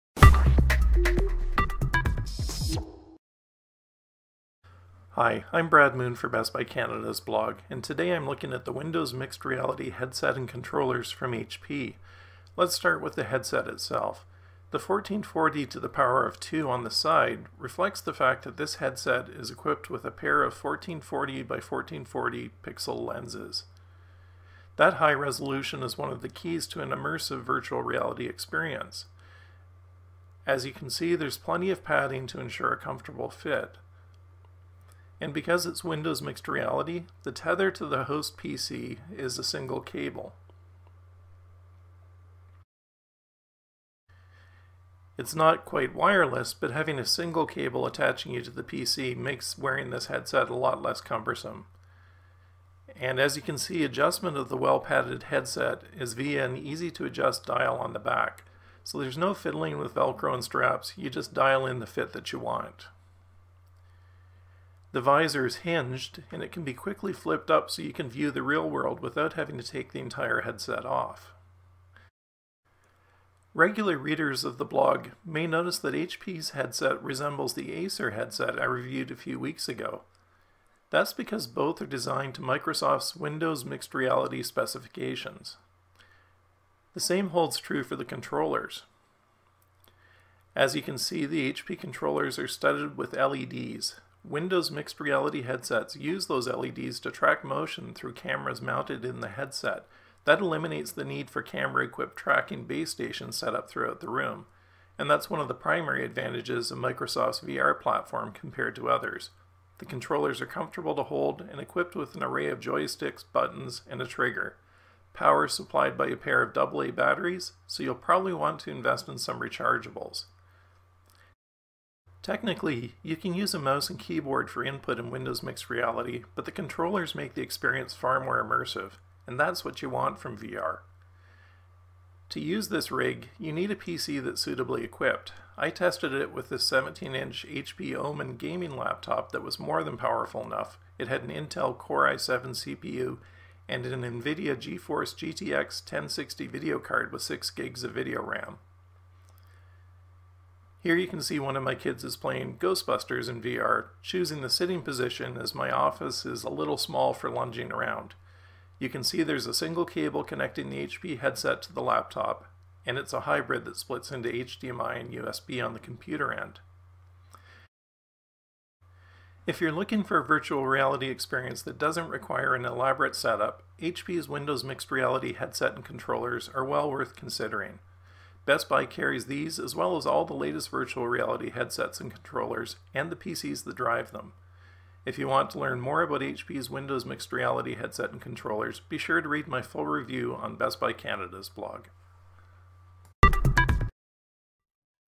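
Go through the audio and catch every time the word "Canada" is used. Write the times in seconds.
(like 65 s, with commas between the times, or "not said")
6 s, 190 s.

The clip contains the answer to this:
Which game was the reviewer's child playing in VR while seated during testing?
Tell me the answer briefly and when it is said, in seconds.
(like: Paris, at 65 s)
Ghostbusters, at 152 s.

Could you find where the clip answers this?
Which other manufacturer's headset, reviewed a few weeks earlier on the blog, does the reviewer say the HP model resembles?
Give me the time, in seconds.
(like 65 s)
77 s.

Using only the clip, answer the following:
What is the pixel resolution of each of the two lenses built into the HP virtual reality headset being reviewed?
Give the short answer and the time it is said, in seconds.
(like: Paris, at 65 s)
1440 by 1440, at 20 s.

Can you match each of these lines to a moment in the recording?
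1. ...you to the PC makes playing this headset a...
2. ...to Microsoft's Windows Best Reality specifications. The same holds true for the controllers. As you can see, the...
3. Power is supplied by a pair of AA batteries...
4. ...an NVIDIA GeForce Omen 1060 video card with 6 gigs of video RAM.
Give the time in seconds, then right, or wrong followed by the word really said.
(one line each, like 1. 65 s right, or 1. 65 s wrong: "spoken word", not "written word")
1. 48 s wrong: "wearing", not "playing"
2. 82 s wrong: "Mixed", not "Best"
3. 115 s right
4. 143 s wrong: "GTX", not "Omen".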